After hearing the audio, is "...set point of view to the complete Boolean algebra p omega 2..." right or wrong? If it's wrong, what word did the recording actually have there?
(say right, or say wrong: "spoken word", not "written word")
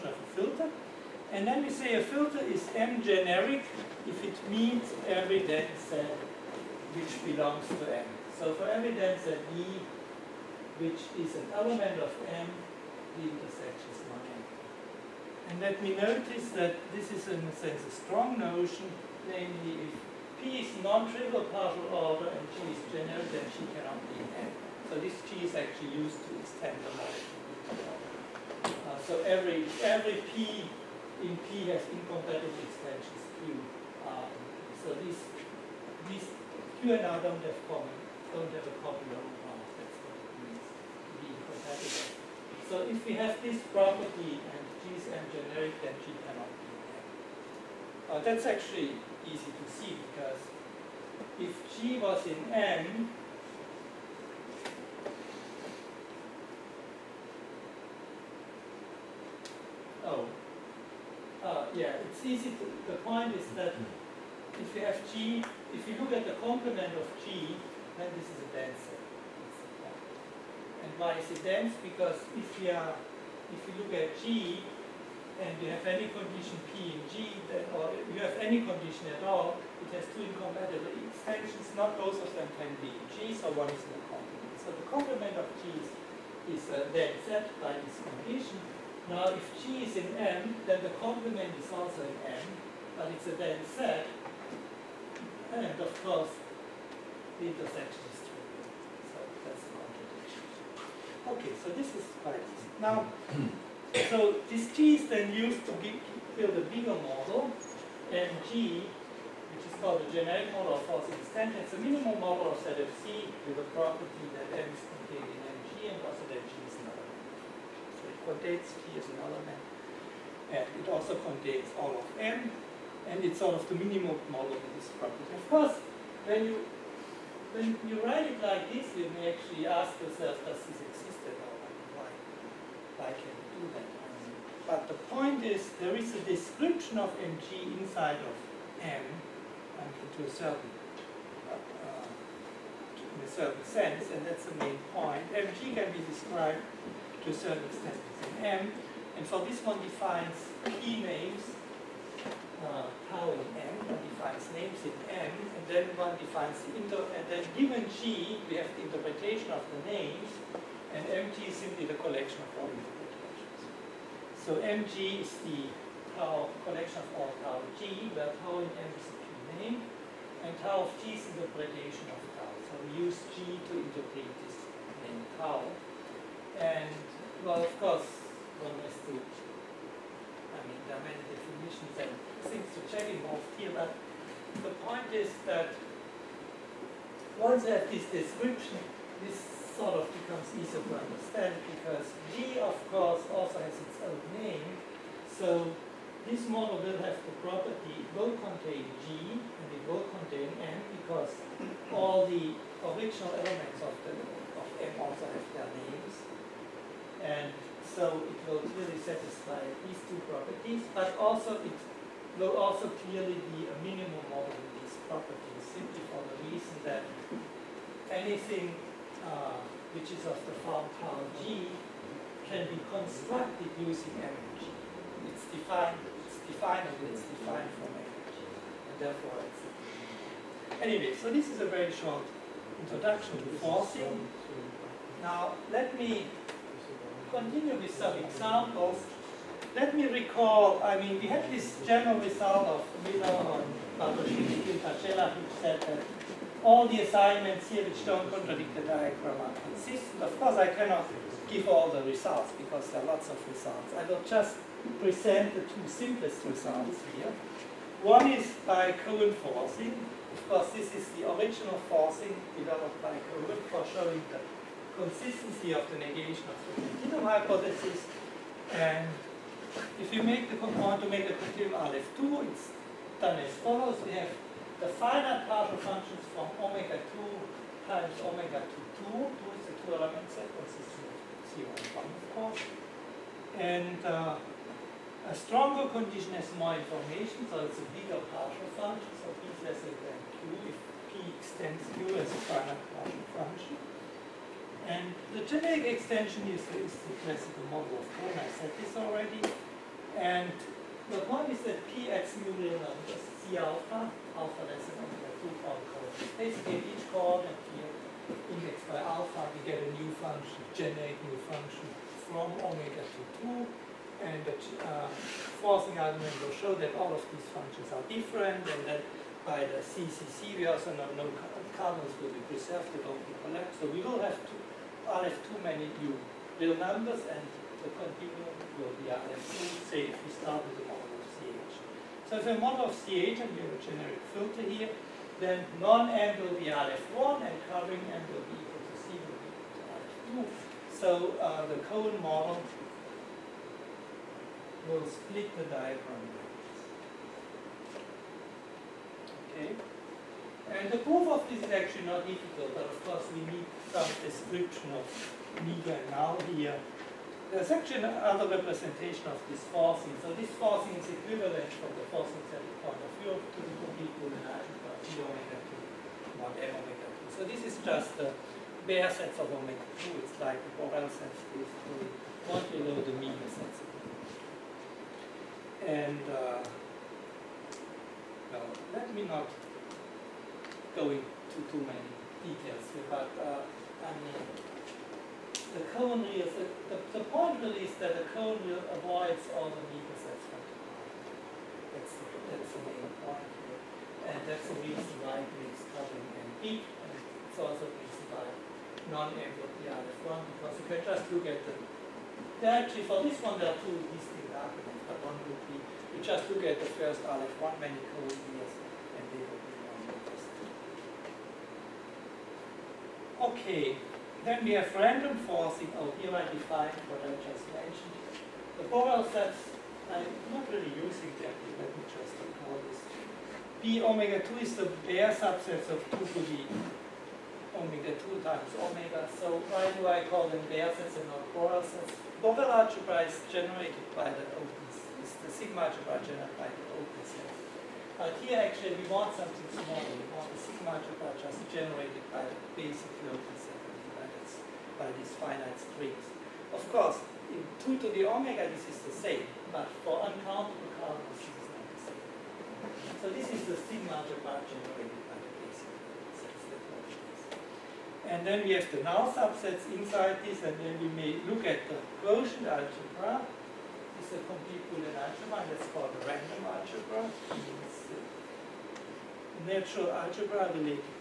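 right.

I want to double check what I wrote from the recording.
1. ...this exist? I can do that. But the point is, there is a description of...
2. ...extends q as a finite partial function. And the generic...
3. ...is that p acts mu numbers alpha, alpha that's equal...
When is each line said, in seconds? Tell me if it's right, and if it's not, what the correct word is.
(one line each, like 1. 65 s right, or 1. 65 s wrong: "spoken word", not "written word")
1. 130 s right
2. 291 s right
3. 301 s right.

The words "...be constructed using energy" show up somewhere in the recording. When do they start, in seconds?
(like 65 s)
222 s.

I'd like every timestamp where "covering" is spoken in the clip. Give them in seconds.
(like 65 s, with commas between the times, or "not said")
337 s, 395 s.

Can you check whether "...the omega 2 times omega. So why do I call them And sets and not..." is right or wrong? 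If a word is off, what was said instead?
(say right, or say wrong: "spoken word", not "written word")
wrong: "Baire", not "And".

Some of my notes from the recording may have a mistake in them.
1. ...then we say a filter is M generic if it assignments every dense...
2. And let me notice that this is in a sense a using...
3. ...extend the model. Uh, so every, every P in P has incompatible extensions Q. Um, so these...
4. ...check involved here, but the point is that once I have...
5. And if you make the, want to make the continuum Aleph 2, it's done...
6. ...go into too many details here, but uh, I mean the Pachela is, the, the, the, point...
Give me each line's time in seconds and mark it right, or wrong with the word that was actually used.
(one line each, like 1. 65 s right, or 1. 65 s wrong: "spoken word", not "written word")
1. 1 s wrong: "meets", not "assignments"
2. 15 s wrong: "strong", not "using"
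3. 26 s right
4. 182 s right
5. 268 s right
6. 380 s wrong: "Cohen", not "Pachela".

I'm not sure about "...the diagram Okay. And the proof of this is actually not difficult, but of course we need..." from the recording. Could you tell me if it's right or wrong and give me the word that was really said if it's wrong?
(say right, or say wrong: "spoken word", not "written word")
right.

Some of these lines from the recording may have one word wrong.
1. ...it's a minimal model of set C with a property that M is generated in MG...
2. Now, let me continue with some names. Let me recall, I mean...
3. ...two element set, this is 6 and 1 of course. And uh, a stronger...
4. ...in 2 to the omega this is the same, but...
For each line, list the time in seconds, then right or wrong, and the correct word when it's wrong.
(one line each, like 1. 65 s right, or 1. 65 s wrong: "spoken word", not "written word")
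1. 111 s wrong: "contained", not "generated"
2. 235 s wrong: "examples", not "names"
3. 279 s wrong: "0", not "6"
4. 447 s right.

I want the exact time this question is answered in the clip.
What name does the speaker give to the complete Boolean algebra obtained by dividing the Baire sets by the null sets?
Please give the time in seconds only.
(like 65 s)
466 s.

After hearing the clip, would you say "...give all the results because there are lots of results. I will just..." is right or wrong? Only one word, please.
right.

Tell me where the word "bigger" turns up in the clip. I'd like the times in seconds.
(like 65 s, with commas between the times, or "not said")
106 s, 287 s.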